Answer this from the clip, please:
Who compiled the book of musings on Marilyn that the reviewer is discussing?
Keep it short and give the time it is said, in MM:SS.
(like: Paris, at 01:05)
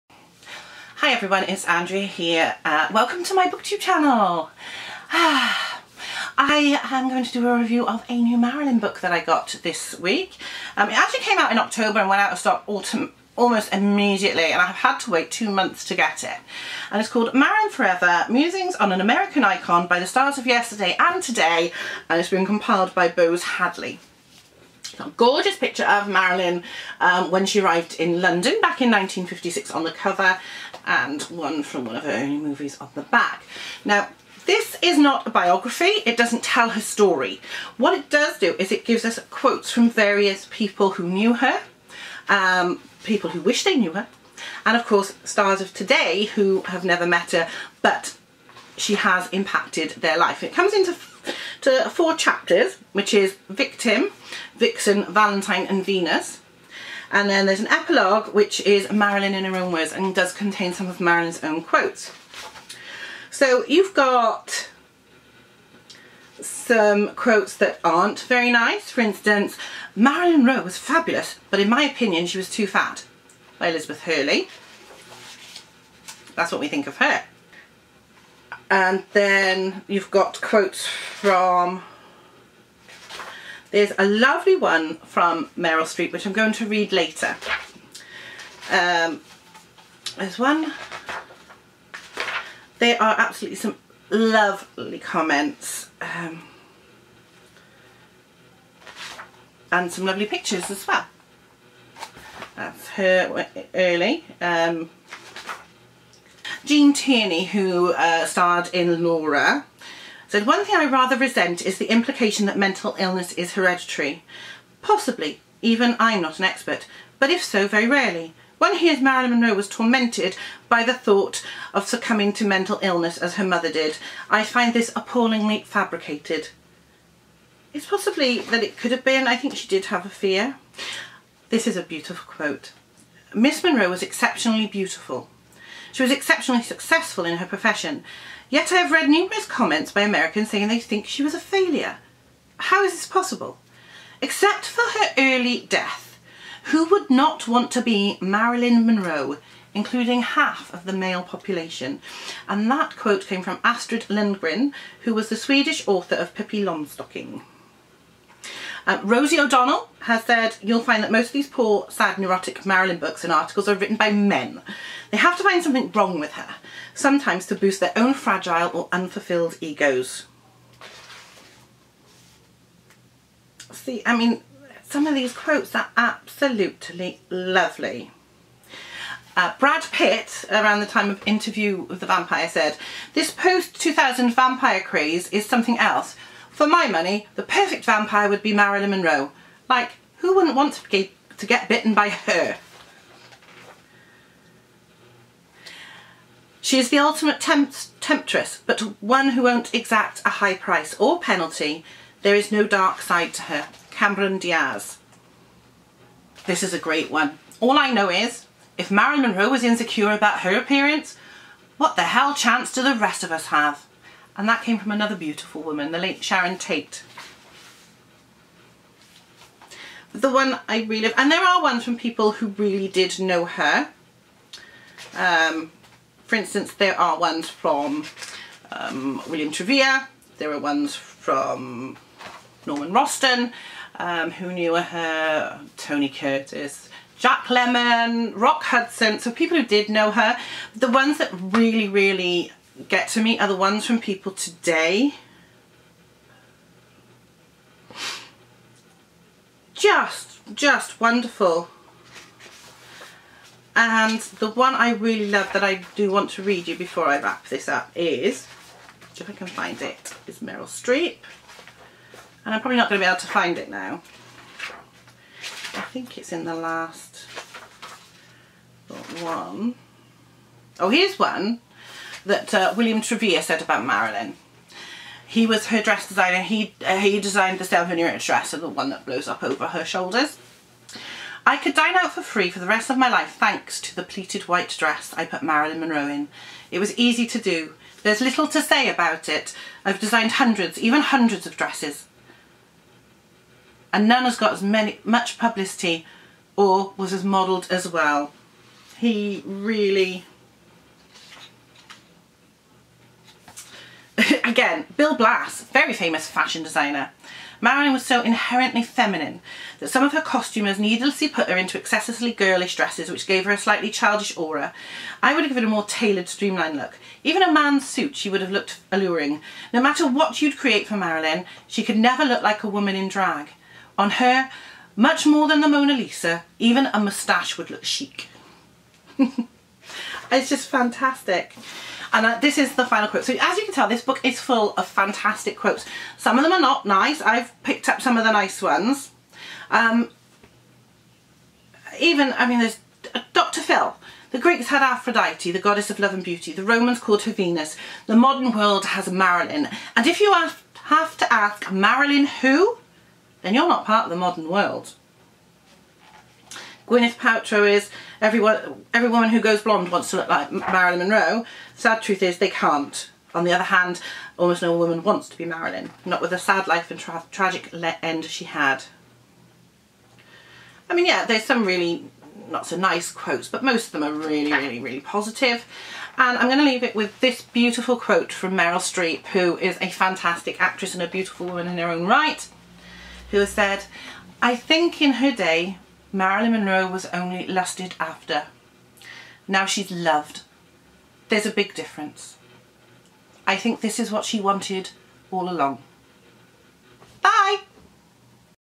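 Boze Hadleigh, at 00:23.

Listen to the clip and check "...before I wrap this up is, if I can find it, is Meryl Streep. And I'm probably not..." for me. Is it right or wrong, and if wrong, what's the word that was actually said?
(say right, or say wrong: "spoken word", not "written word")
right.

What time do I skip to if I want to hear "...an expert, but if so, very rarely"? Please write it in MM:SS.
01:56.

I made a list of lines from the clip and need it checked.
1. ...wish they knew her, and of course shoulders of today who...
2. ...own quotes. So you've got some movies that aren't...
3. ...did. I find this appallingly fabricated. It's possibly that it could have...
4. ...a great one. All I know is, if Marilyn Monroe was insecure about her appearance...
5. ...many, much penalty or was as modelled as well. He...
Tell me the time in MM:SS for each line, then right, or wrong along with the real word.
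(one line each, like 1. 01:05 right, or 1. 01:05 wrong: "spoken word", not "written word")
1. 00:43 wrong: "stars", not "shoulders"
2. 01:01 wrong: "quotes", not "movies"
3. 02:03 right
4. 03:26 right
5. 04:54 wrong: "publicity", not "penalty".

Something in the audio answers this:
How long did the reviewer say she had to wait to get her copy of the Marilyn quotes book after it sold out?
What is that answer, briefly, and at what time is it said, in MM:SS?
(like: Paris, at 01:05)
2 months, at 00:15.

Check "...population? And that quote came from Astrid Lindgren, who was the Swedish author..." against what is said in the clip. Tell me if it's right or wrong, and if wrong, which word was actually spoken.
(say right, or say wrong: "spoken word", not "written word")
right.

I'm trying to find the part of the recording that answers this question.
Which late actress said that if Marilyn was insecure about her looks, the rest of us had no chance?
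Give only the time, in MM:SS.
03:36.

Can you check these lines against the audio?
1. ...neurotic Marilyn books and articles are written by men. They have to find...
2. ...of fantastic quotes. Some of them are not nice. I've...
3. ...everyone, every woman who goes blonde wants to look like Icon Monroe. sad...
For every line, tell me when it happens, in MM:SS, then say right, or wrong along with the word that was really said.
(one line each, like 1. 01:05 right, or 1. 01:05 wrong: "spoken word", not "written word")
1. 02:42 right
2. 05:34 right
3. 05:58 wrong: "Marilyn", not "Icon".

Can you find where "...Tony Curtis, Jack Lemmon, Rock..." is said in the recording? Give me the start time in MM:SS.
03:55.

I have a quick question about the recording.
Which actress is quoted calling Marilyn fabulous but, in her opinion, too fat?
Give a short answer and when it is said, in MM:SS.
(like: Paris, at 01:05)
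Elizabeth Hurley, at 01:13.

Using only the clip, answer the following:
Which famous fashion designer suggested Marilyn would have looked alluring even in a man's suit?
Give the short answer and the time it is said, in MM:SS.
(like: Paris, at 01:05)
Bill Blass, at 05:04.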